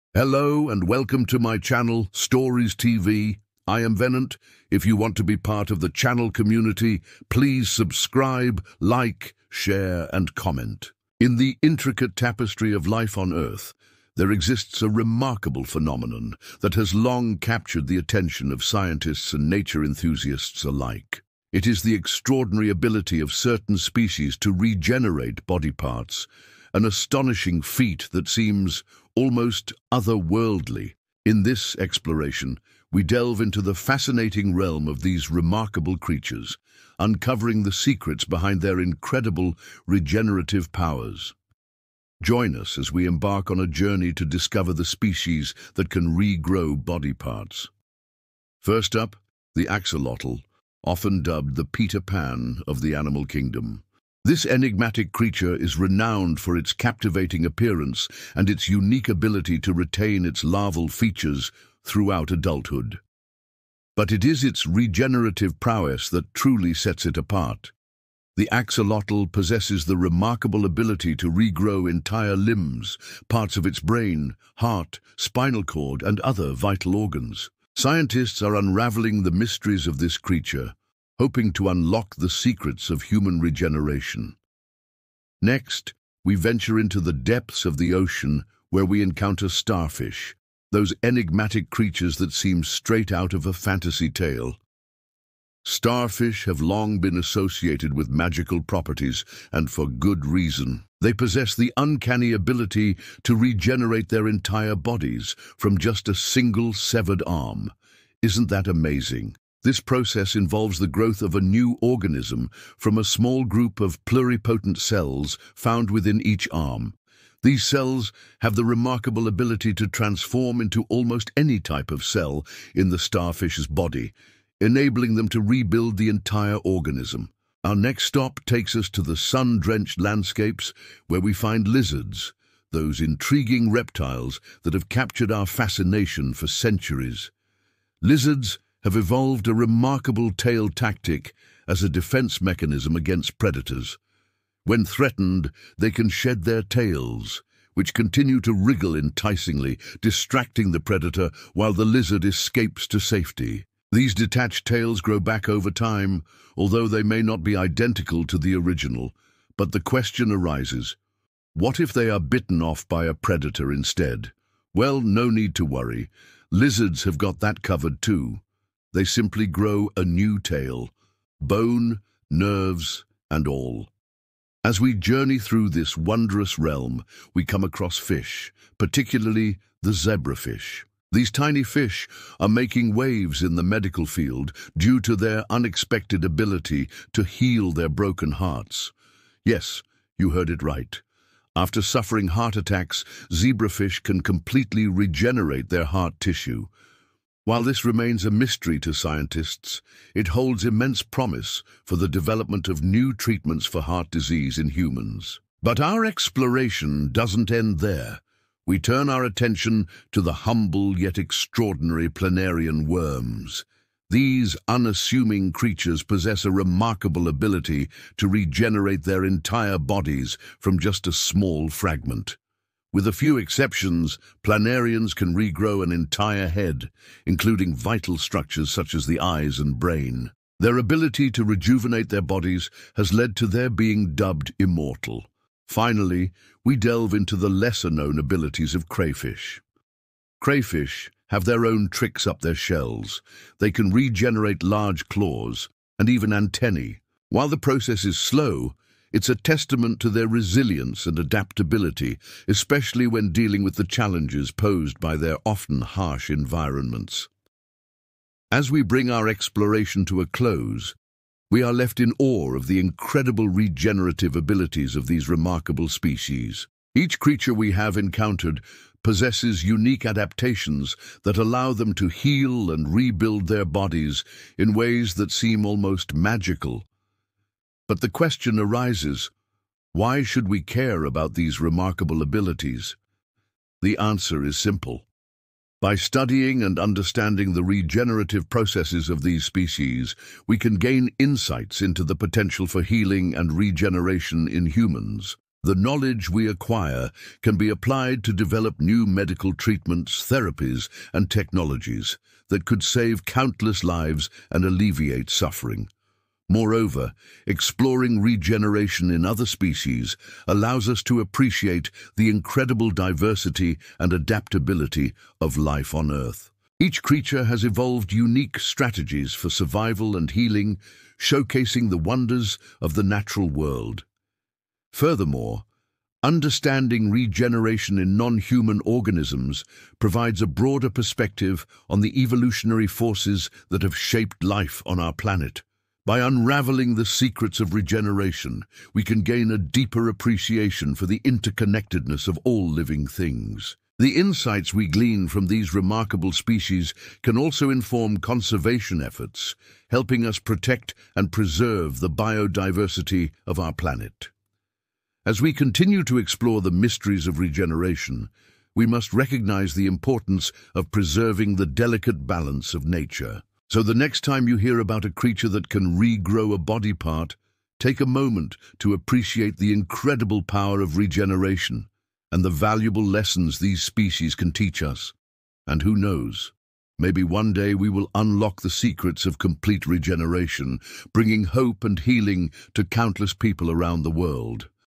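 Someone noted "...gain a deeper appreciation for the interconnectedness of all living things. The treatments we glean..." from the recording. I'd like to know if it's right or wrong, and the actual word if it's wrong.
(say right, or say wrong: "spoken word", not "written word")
wrong: "insights", not "treatments".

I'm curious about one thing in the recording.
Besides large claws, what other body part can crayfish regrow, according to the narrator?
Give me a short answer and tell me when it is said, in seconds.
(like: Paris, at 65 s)
antennae, at 246 s.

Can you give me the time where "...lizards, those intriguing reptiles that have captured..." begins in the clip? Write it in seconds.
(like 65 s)
131 s.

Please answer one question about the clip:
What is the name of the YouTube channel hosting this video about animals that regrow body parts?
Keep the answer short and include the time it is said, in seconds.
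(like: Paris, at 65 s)
Stories TV, at 2 s.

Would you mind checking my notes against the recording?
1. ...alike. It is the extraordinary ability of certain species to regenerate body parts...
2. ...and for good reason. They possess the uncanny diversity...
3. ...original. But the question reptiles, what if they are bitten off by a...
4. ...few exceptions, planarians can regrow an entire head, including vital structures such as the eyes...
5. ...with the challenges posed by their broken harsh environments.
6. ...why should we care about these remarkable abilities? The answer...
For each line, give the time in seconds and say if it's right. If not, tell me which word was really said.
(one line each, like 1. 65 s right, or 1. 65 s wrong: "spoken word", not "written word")
1. 20 s right
2. 99 s wrong: "ability", not "diversity"
3. 158 s wrong: "arises", not "reptiles"
4. 223 s right
5. 253 s wrong: "often", not "broken"
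6. 279 s right.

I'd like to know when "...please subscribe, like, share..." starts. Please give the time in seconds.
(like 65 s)
7 s.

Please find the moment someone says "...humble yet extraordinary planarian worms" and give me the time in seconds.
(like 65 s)
210 s.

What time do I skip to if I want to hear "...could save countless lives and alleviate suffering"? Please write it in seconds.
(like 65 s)
302 s.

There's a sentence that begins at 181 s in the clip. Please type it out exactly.
These tiny fish are making waves in the medical field due to their unexpected ability to heal their broken hearts.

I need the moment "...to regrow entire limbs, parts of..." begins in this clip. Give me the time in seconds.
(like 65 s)
71 s.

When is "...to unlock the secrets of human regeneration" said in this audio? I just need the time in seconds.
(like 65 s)
81 s.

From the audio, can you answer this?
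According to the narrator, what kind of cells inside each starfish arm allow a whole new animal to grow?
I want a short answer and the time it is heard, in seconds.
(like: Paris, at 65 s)
pluripotent cells, at 114 s.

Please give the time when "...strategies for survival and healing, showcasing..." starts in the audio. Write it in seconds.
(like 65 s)
318 s.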